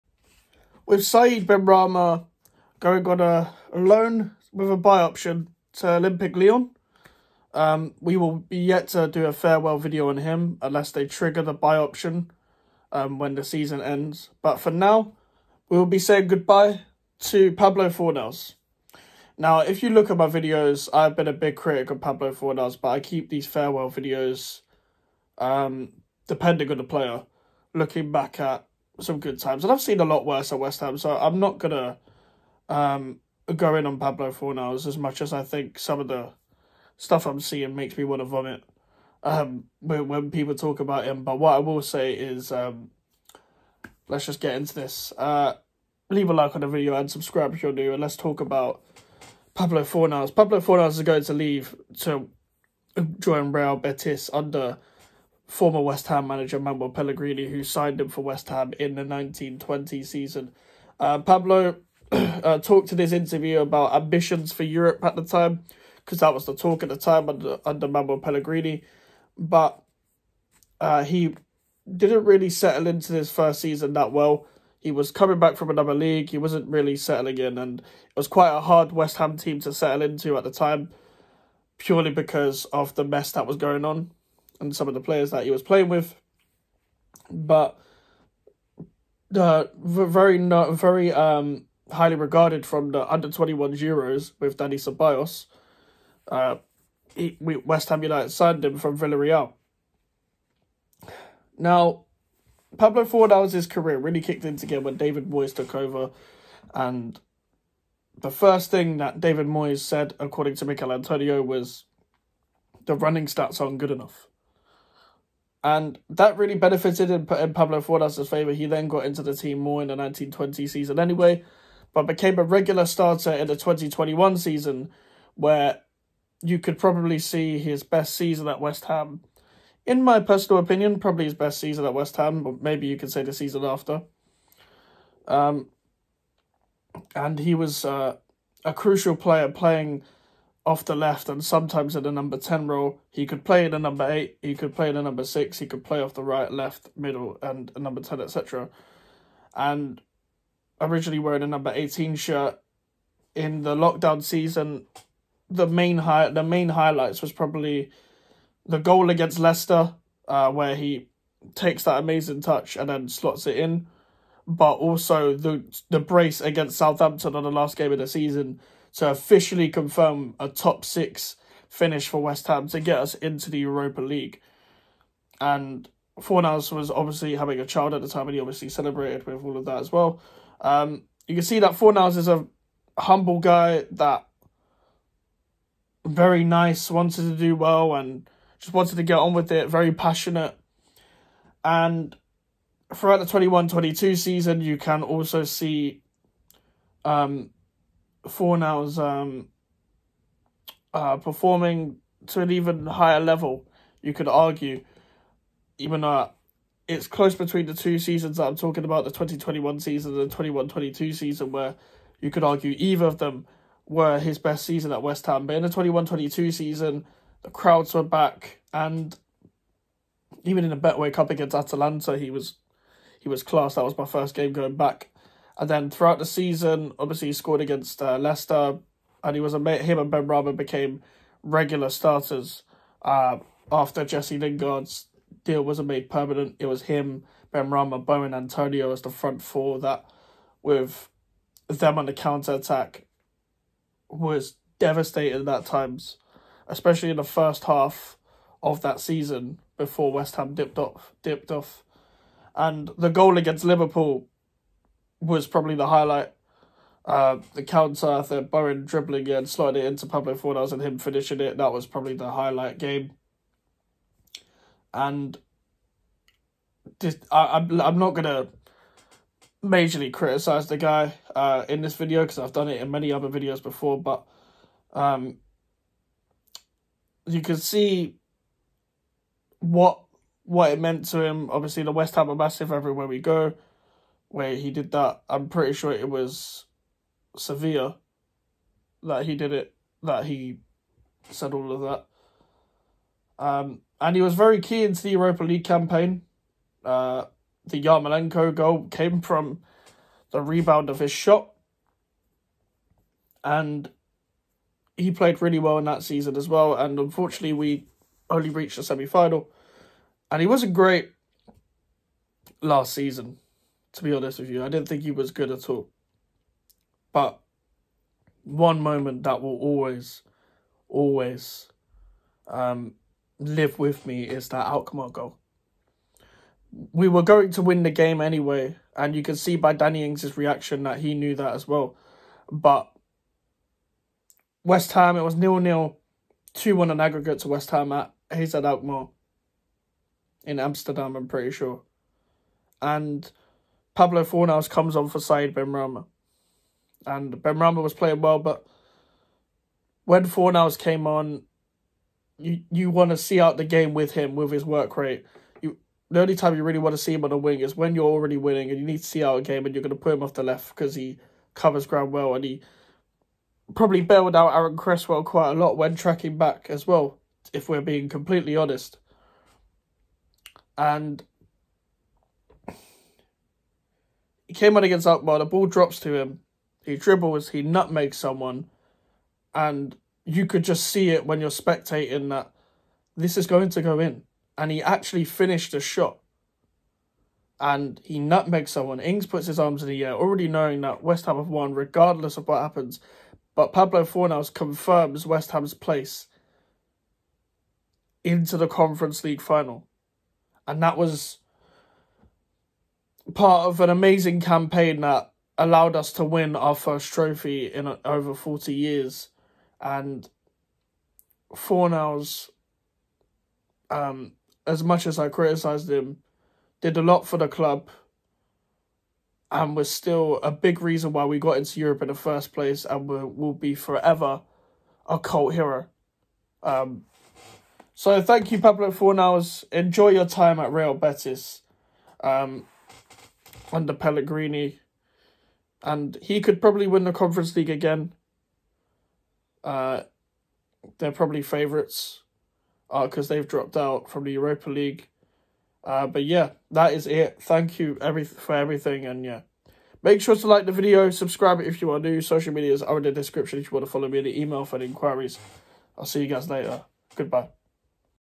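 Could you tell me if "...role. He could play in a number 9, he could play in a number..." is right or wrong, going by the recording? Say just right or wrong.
wrong.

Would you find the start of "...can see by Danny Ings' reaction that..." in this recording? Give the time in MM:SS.
05:29.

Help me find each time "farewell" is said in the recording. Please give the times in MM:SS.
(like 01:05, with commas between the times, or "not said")
00:09, 00:23.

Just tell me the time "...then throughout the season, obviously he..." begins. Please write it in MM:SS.
03:45.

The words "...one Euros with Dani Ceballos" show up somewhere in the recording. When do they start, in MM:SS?
01:33.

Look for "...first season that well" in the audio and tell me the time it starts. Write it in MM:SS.
01:13.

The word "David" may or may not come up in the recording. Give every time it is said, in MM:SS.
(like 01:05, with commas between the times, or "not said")
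01:44, 01:49.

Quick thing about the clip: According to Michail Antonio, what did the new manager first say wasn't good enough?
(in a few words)
The running stats.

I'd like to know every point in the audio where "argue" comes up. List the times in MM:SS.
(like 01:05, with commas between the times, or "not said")
03:24, 03:32.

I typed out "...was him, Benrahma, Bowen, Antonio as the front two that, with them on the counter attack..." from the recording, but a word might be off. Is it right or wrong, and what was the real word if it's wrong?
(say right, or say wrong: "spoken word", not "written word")
wrong: "four", not "two".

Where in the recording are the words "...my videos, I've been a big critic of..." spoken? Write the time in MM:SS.
00:20.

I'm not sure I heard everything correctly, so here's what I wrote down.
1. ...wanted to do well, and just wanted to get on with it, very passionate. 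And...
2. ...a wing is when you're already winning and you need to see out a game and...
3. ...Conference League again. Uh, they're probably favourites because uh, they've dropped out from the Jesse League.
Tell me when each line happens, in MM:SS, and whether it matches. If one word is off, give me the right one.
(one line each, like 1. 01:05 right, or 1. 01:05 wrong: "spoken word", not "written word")
1. 03:06 right
2. 05:57 right
3. 07:17 wrong: "Europa", not "Jesse".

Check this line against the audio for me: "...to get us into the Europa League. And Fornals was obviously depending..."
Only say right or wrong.
wrong.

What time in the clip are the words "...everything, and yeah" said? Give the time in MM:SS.
07:28.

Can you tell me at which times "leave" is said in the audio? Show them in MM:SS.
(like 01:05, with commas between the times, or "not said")
00:46, 00:51.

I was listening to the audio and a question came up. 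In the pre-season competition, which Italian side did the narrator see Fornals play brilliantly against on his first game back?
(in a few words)
Atalanta.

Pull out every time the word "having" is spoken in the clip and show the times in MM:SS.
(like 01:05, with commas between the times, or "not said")
02:57.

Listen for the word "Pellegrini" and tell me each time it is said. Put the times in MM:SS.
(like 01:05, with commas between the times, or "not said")
00:56, 01:08, 07:13.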